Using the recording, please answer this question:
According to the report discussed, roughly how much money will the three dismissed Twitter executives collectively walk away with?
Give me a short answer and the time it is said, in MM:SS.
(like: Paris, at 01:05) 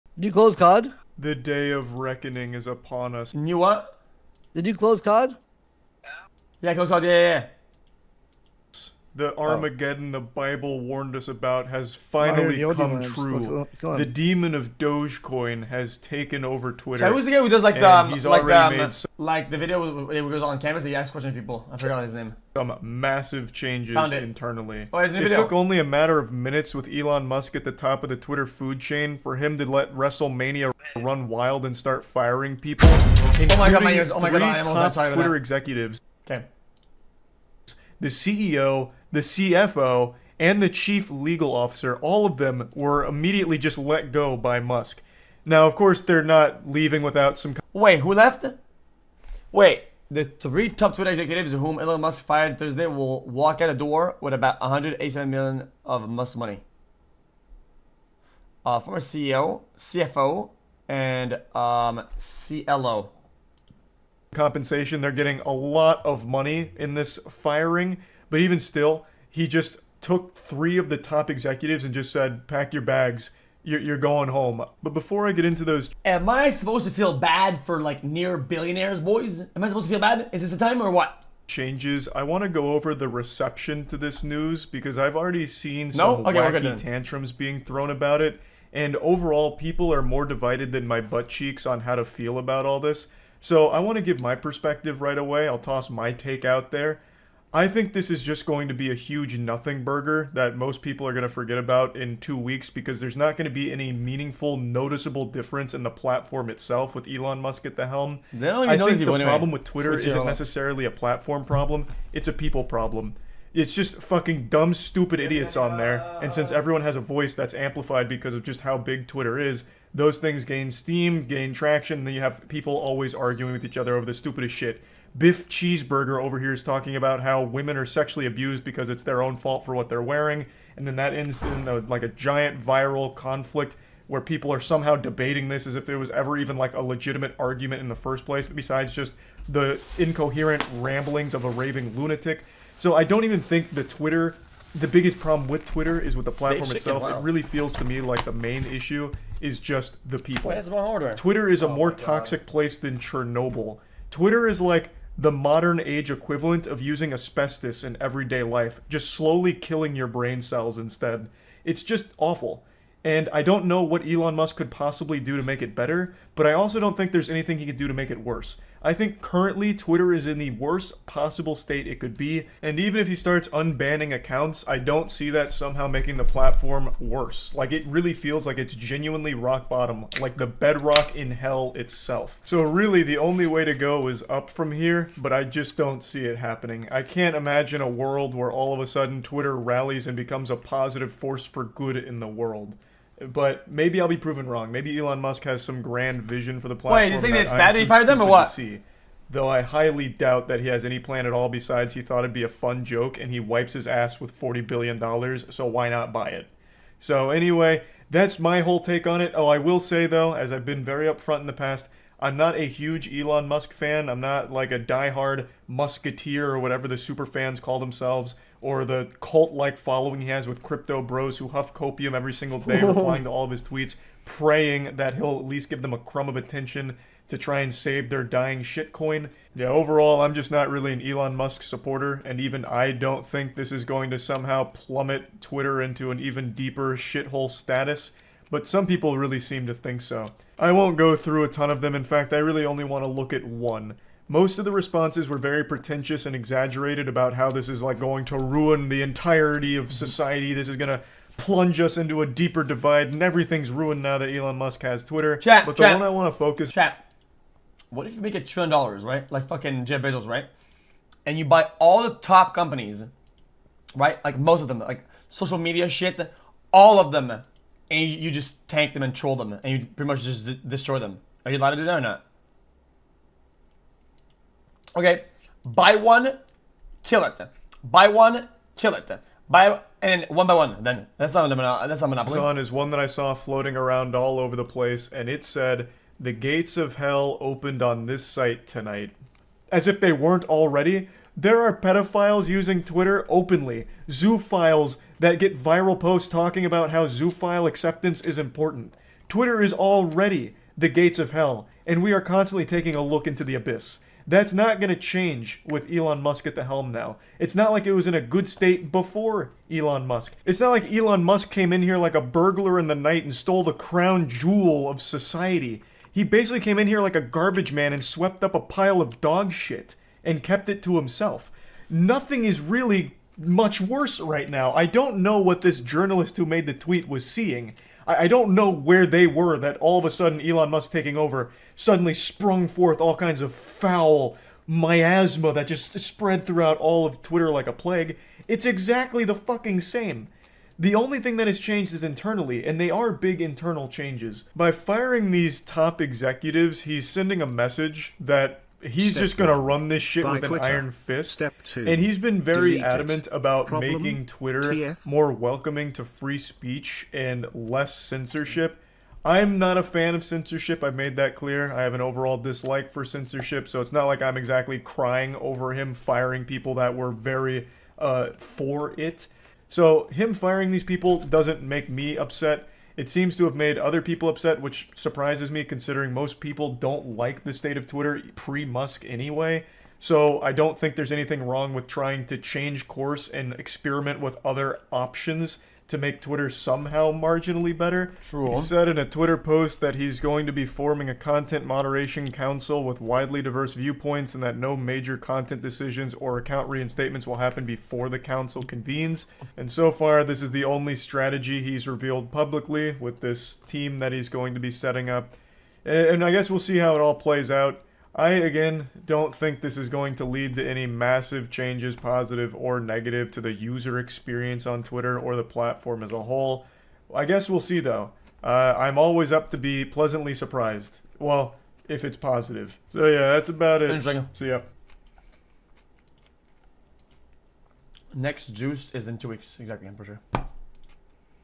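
187 million, at 00:54.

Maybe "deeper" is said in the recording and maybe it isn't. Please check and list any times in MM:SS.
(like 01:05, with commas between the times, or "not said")
03:56, 04:12.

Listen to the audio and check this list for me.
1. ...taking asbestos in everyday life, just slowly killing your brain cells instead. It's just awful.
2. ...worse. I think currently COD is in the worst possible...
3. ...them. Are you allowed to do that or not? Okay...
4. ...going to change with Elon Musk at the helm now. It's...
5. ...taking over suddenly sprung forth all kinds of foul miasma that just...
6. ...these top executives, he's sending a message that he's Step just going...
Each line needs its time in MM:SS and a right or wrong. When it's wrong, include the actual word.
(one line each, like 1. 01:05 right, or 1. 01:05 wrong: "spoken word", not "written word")
1. 02:36 wrong: "using", not "taking"
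2. 02:48 wrong: "Twitter", not "COD"
3. 04:30 right
4. 05:04 right
5. 05:30 right
6. 05:45 right.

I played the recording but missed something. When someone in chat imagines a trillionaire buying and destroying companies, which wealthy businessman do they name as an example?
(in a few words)
Jeff Bezos.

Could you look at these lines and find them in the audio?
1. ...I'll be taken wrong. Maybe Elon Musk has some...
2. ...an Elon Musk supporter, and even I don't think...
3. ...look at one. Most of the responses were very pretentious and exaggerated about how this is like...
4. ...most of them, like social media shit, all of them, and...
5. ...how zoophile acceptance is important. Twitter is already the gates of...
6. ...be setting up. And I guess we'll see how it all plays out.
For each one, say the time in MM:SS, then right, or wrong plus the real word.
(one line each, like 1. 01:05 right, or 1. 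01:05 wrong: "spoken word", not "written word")
1. 03:14 wrong: "proven", not "taken"
2. 03:50 right
3. 04:03 right
4. 04:24 right
5. 04:56 right
6. 06:44 right.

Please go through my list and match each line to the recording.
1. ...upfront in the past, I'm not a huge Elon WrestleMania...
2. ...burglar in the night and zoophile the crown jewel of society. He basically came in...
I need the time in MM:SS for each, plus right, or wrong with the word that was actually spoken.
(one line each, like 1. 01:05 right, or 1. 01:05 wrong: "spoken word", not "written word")
1. 03:31 wrong: "Musk", not "WrestleMania"
2. 05:12 wrong: "stole", not "zoophile".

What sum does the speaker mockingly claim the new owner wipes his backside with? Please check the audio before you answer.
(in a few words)
$40 billion.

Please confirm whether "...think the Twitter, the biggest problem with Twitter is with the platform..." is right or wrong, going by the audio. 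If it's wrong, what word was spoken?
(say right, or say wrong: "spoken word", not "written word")
right.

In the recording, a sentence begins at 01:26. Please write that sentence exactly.
okay, wacky tantrums being thrown about it.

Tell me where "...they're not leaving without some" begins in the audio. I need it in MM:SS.
00:46.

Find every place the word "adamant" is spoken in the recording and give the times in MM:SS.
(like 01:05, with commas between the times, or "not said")
05:52.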